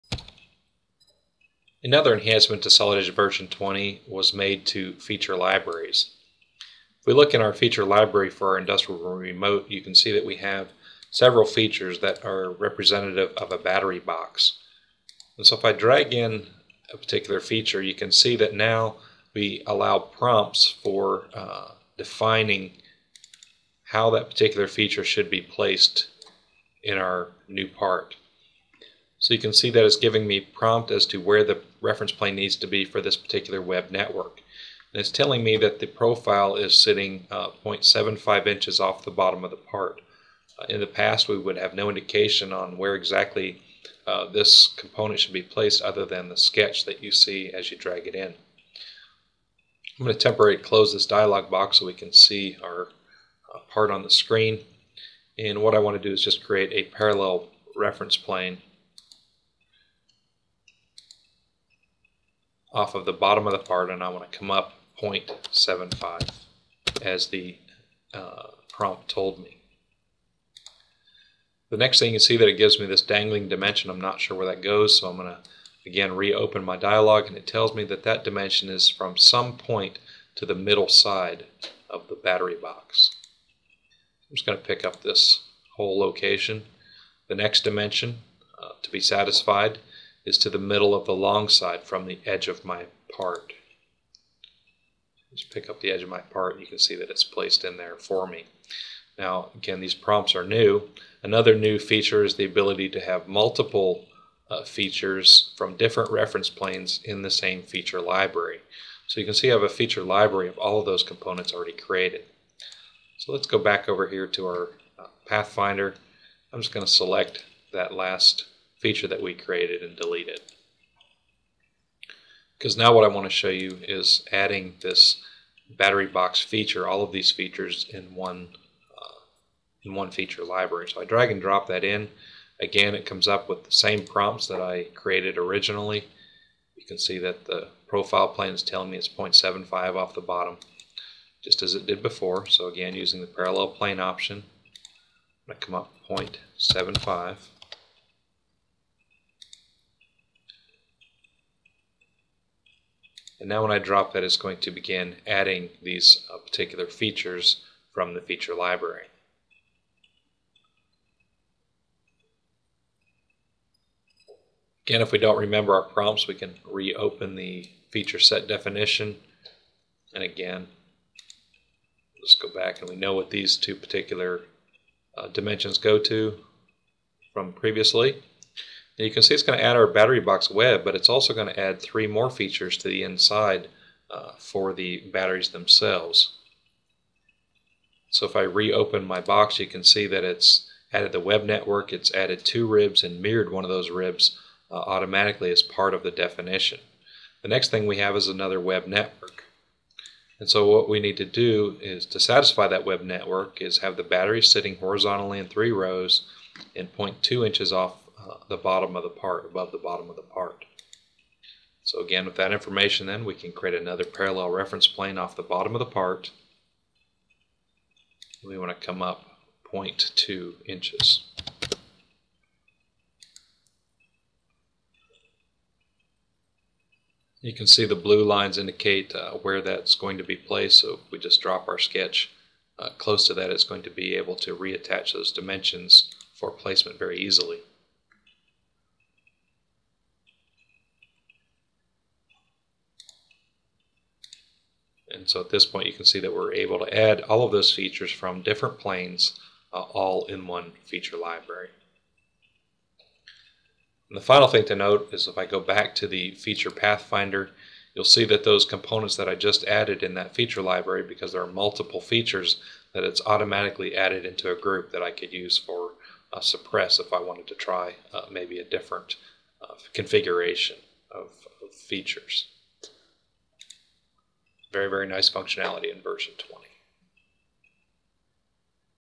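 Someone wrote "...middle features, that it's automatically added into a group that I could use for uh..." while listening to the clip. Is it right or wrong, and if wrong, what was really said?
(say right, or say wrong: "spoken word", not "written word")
wrong: "multiple", not "middle".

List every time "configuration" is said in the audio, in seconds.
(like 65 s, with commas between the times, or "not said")
269 s.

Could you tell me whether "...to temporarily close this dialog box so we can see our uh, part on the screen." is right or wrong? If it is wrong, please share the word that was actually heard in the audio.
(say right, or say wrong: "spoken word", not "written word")
right.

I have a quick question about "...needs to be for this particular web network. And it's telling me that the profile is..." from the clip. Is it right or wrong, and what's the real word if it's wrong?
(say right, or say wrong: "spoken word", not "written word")
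right.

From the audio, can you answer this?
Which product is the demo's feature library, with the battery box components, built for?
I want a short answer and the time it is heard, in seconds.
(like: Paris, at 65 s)
Industrial remote, at 8 s.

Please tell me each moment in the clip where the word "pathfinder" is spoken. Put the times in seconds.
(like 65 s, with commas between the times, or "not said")
115 s, 256 s.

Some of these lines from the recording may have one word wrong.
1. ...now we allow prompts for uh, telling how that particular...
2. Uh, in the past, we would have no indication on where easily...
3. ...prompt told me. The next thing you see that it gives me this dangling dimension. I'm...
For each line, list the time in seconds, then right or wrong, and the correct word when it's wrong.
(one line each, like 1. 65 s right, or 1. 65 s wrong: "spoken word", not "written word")
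1. 18 s wrong: "defining", not "telling"
2. 40 s wrong: "exactly", not "easily"
3. 68 s right.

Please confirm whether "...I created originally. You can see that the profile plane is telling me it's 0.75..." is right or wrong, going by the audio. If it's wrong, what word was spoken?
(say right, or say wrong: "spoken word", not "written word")
right.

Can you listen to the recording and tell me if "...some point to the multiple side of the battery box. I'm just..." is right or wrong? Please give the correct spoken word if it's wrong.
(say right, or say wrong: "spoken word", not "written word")
wrong: "middle", not "multiple".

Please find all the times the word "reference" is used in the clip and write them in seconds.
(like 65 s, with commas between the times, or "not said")
31 s, 57 s, 106 s, 214 s.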